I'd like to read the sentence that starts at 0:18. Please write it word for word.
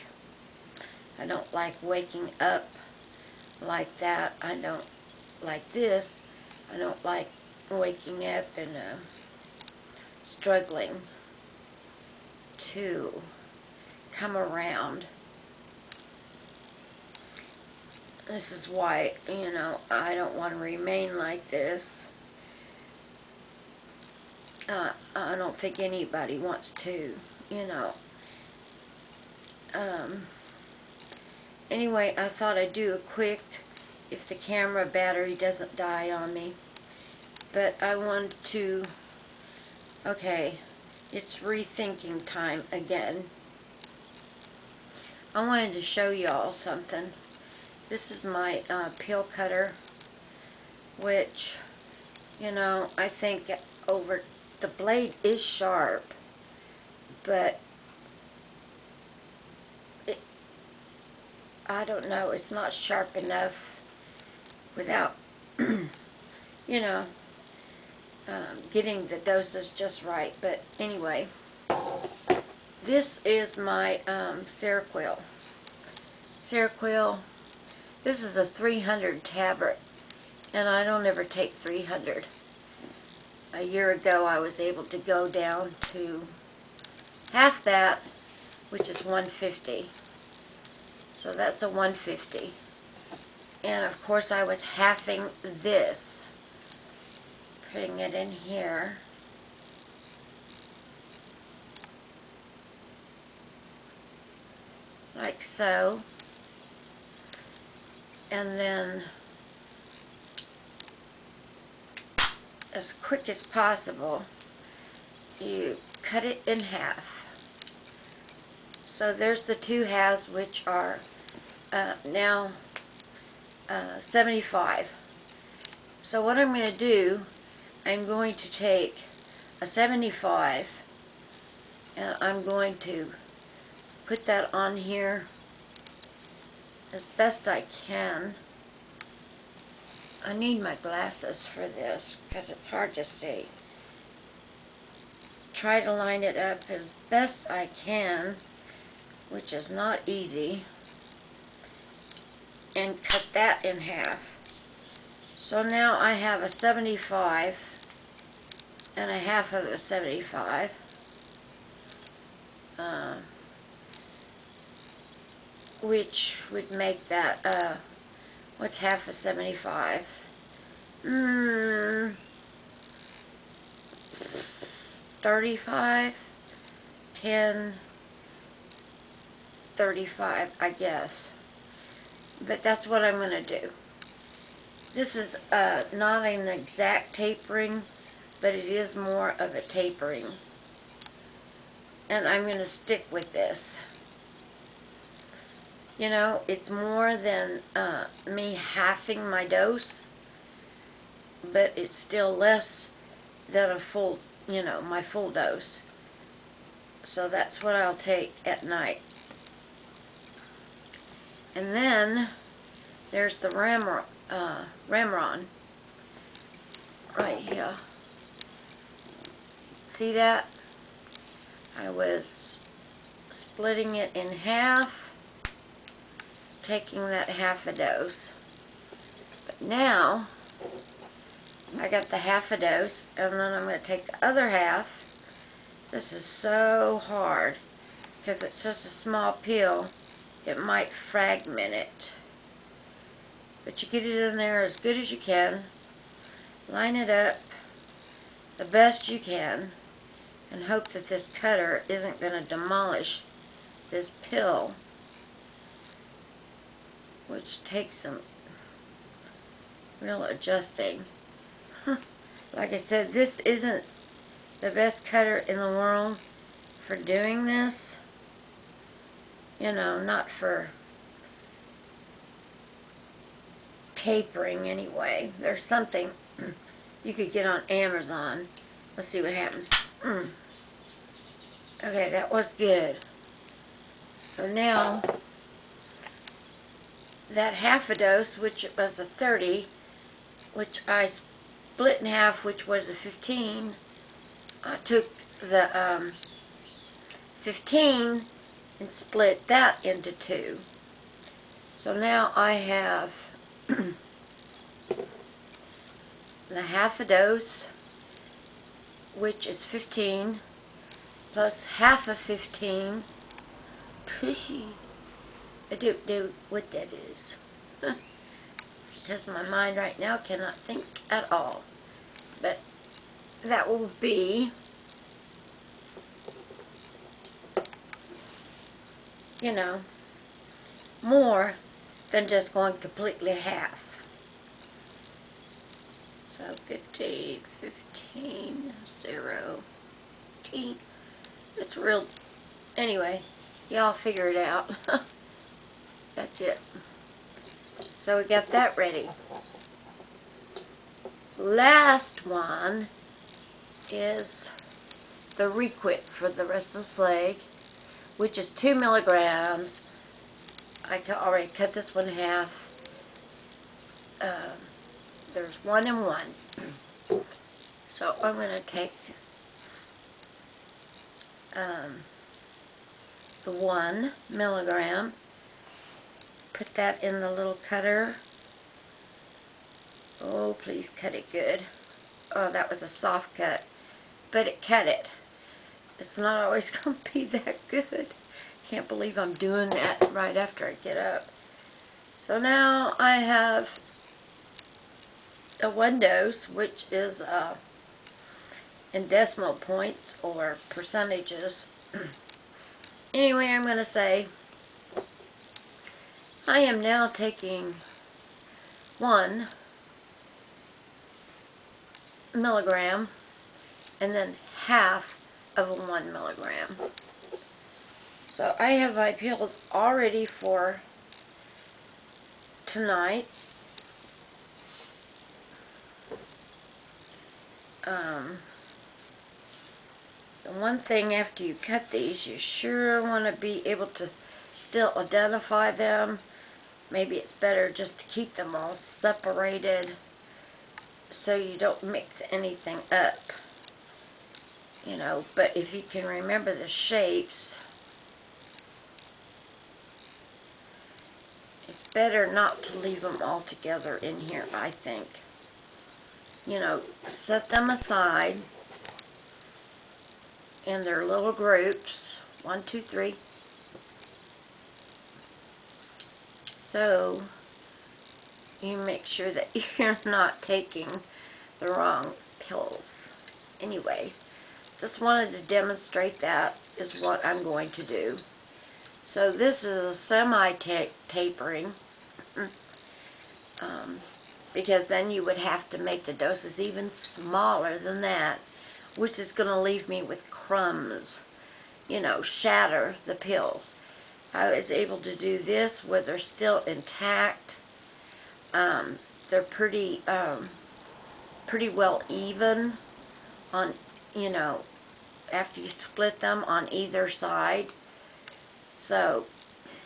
This is why, you know, I don't want to remain like this.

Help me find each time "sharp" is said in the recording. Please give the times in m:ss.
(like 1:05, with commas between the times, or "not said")
0:55, 1:02.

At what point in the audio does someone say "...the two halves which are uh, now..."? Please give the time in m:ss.
1:59.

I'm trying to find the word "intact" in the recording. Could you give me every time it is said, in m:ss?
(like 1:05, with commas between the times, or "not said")
8:16.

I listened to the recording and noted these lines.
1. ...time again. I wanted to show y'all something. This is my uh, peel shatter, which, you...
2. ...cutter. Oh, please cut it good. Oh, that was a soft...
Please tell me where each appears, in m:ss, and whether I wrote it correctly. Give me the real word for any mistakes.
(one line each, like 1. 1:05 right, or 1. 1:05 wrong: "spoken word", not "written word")
1. 0:42 wrong: "cutter", not "shatter"
2. 6:17 right.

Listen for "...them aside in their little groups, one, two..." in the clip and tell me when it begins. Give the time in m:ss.
7:37.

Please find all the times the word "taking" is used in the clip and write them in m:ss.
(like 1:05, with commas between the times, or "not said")
3:46, 6:47, 7:50.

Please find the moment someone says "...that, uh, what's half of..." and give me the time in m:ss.
2:47.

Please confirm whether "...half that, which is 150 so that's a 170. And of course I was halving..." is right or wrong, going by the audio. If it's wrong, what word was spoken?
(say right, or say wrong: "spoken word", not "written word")
wrong: "150", not "170".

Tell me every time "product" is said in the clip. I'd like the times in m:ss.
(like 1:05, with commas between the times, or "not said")
not said.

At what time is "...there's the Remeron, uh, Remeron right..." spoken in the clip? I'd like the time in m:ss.
3:33.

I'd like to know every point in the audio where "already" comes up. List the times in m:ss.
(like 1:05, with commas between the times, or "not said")
6:01, 6:59.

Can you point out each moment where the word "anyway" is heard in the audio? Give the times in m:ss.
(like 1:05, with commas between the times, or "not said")
0:31, 1:10, 4:34, 5:42, 6:43, 7:53.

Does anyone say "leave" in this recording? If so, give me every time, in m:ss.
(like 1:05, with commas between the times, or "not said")
7:32, 8:09.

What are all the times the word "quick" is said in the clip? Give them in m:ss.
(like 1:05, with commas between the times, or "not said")
0:32, 1:53.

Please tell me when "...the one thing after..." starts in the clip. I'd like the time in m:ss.
7:10.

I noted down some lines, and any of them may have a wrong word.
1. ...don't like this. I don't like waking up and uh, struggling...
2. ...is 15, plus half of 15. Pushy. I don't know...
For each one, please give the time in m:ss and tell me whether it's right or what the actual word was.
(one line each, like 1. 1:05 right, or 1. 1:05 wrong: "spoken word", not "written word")
1. 0:04 right
2. 5:09 right.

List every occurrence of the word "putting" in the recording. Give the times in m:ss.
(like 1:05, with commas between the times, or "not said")
1:37.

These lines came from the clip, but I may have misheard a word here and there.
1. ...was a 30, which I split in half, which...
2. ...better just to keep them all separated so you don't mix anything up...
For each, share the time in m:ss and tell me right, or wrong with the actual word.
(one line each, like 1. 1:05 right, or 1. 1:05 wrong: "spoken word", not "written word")
1. 4:48 right
2. 7:17 right.